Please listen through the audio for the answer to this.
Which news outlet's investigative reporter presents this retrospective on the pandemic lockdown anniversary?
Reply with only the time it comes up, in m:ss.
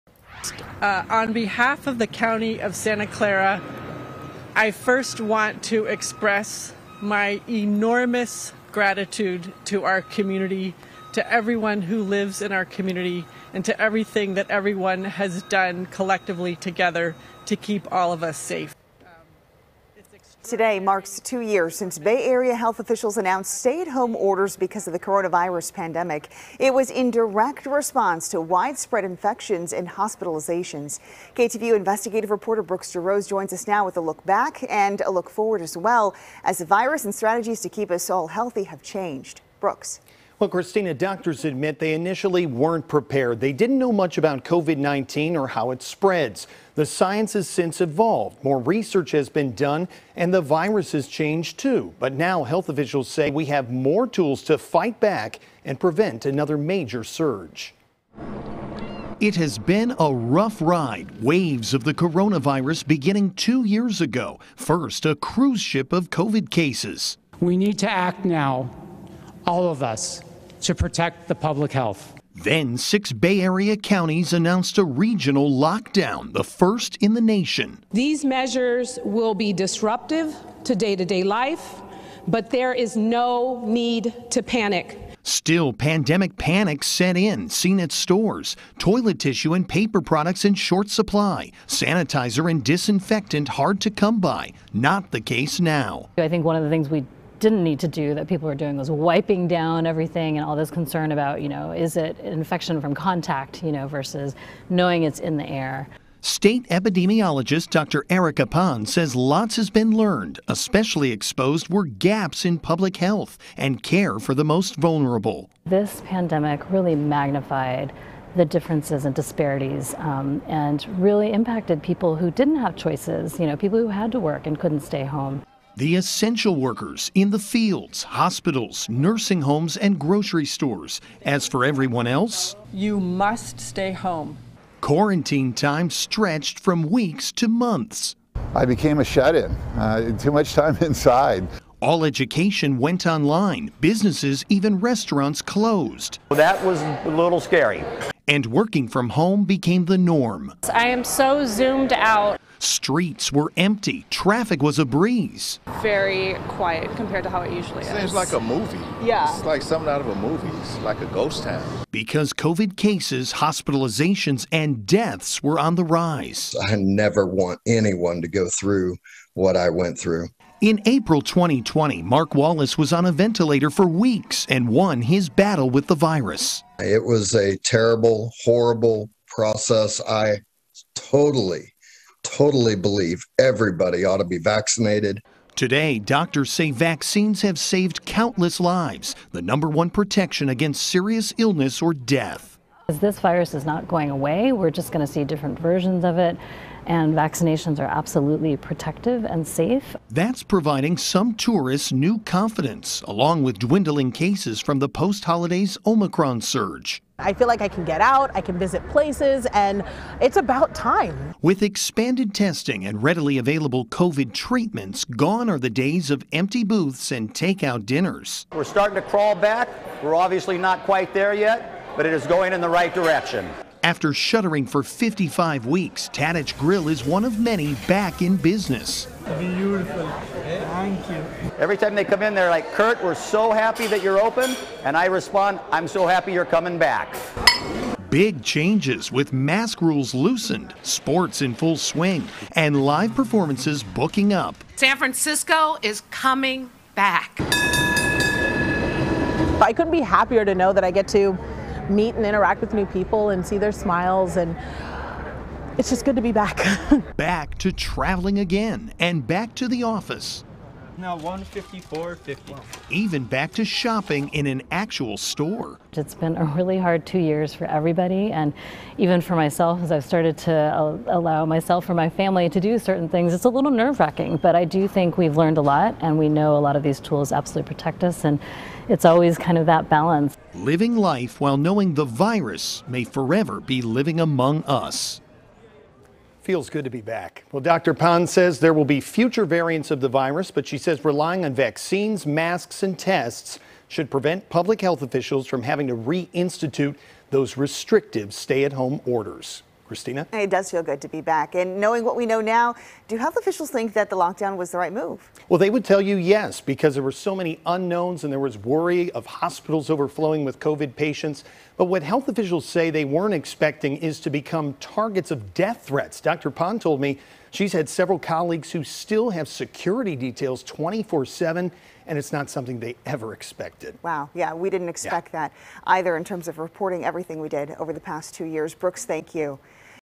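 0:31.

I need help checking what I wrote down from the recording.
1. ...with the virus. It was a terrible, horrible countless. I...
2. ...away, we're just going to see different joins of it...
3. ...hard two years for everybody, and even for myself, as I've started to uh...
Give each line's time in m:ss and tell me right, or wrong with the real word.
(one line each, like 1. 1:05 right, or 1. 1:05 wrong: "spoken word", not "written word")
1. 2:55 wrong: "process", not "countless"
2. 3:14 wrong: "versions", not "joins"
3. 4:26 right.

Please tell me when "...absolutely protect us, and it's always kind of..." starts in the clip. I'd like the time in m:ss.
4:37.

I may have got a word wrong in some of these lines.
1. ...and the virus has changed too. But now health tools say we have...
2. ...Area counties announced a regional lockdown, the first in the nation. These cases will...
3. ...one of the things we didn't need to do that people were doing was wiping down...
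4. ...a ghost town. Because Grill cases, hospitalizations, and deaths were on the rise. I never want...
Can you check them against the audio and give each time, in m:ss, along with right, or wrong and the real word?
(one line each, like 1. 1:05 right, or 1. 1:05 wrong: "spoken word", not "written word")
1. 0:50 wrong: "officials", not "tools"
2. 1:13 wrong: "measures", not "cases"
3. 1:36 right
4. 2:41 wrong: "COVID", not "Grill".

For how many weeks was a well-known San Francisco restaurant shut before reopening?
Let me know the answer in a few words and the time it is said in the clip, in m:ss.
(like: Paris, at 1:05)
55, at 3:44.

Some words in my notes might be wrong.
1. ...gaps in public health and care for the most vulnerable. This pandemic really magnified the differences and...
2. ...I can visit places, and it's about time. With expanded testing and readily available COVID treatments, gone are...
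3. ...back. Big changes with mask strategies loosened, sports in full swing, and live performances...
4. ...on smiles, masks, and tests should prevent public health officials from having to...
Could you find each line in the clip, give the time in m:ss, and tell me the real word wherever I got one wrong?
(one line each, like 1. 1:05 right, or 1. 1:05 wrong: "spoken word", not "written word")
1. 1:51 right
2. 3:28 right
3. 3:56 wrong: "rules", not "strategies"
4. 4:51 wrong: "vaccines", not "smiles".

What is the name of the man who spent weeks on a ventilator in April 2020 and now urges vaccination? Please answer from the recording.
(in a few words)
Mark Wallace.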